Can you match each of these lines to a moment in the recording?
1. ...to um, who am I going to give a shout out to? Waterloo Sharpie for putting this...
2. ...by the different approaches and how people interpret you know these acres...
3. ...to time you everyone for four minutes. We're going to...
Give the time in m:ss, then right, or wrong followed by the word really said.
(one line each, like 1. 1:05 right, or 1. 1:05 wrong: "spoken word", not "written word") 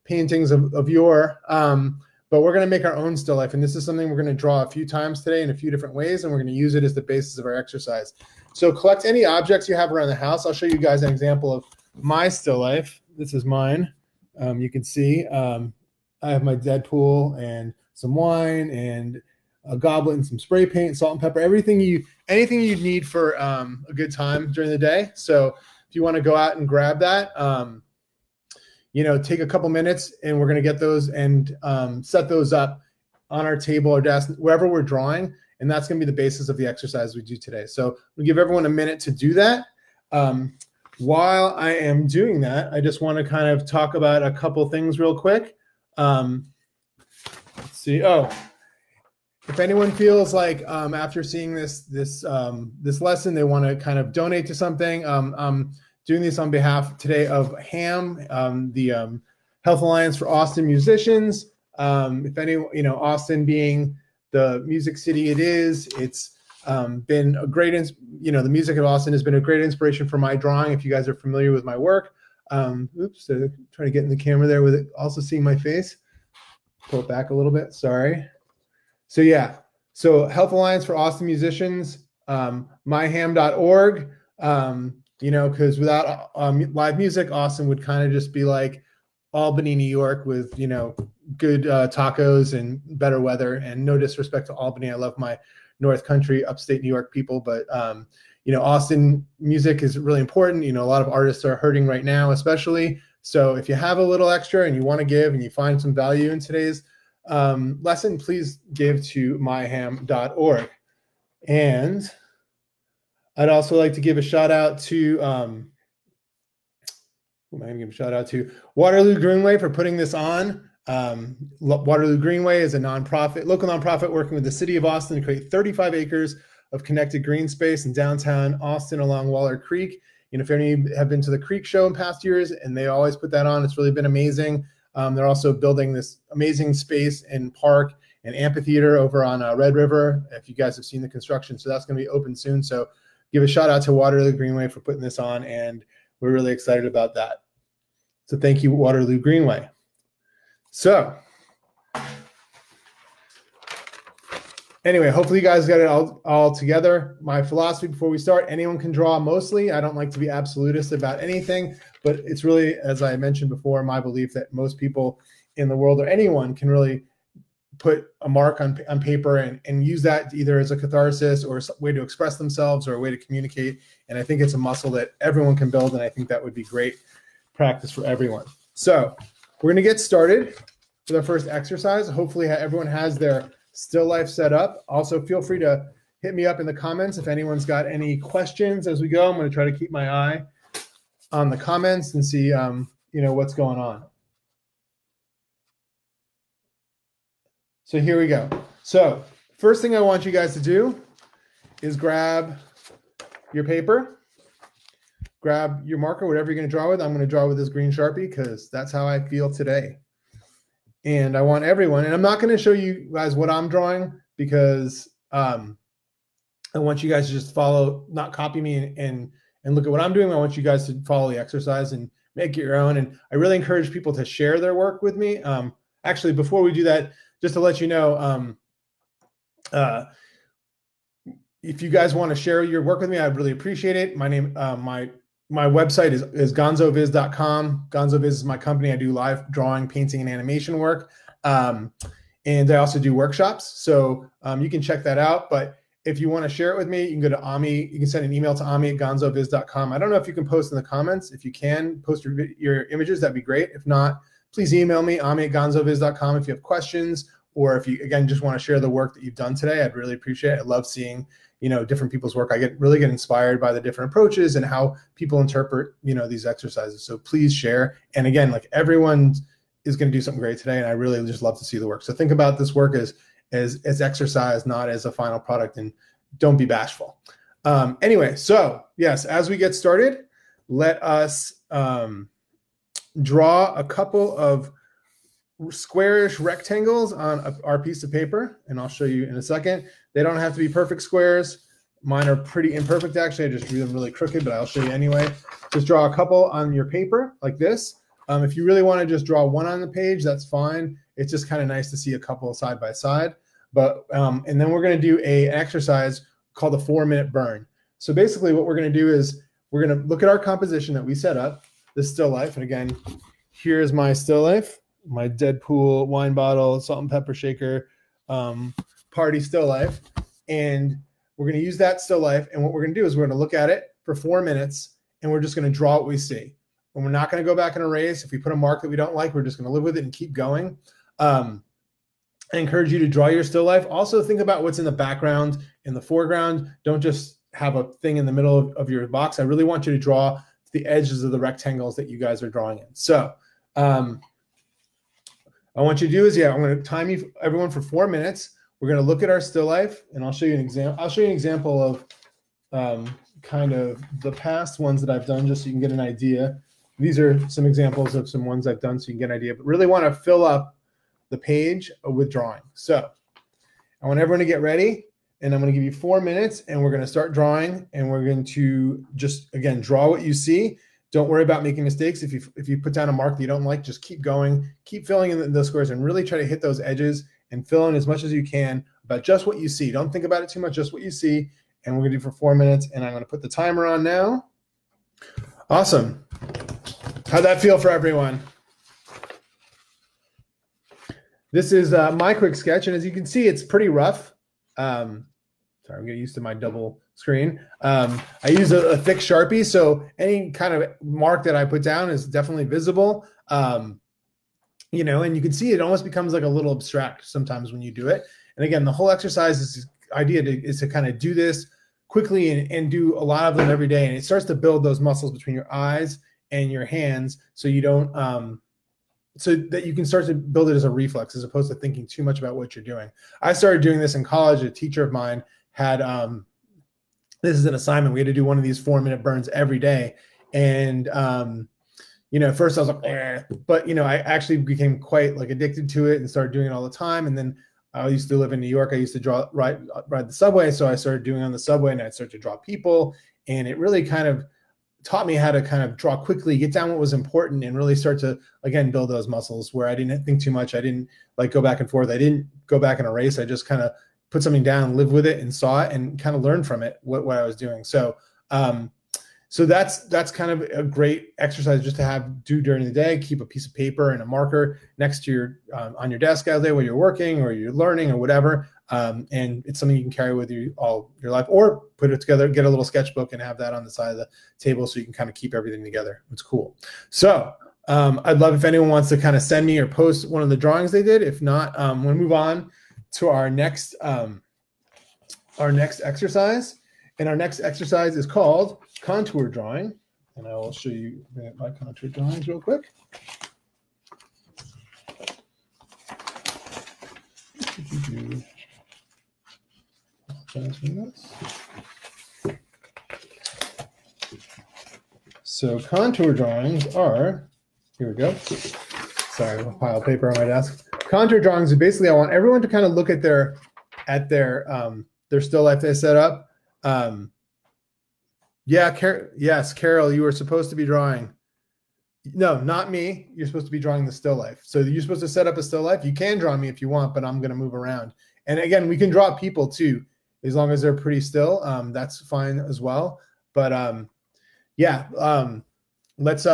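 1. 1:54 wrong: "Greenway", not "Sharpie"
2. 4:23 wrong: "exercises", not "acres"
3. 5:46 right.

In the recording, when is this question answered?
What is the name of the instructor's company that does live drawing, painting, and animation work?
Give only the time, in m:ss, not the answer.
3:57.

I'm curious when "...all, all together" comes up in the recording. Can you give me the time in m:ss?
2:35.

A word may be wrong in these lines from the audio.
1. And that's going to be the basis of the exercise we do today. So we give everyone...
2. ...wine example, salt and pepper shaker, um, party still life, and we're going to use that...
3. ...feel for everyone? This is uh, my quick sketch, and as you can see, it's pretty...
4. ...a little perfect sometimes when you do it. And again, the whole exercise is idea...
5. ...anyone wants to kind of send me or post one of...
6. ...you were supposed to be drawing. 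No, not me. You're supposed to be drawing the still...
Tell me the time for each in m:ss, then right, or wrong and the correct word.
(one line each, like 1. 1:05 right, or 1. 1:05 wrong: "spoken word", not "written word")
1. 0:35 right
2. 5:16 wrong: "bottle", not "example"
3. 6:27 right
4. 6:46 wrong: "abstract", not "perfect"
5. 7:58 right
6. 8:40 right.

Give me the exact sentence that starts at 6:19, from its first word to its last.
Don't think about it too much, just what you see.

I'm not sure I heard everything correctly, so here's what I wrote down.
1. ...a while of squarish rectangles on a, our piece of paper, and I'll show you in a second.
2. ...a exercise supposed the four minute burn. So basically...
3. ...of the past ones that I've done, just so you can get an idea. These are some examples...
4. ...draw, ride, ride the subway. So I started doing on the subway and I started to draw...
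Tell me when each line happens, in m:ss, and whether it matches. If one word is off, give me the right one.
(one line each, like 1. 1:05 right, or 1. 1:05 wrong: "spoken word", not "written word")
1. 4:43 wrong: "couple", not "while"
2. 5:05 wrong: "called", not "supposed"
3. 5:53 right
4. 7:19 right.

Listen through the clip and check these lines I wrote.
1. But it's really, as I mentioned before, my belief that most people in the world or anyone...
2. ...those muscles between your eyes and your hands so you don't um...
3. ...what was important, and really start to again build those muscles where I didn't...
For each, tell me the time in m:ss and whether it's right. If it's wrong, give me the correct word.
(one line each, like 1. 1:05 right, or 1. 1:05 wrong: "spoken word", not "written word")
1. 2:42 right
2. 6:54 right
3. 7:26 right.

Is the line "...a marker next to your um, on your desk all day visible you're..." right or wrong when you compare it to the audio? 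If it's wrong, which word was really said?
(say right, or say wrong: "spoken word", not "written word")
wrong: "while", not "visible".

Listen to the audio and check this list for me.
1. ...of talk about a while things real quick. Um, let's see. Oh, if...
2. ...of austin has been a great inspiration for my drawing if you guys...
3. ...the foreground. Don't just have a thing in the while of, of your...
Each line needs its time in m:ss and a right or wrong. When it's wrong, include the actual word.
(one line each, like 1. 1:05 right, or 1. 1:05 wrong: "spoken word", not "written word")
1. 0:43 wrong: "couple", not "while"
2. 1:08 right
3. 5:35 wrong: "middle", not "while".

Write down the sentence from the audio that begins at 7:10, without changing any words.
And, um, you know, at first I was like, eh.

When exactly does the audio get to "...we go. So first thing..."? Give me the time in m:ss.
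3:18.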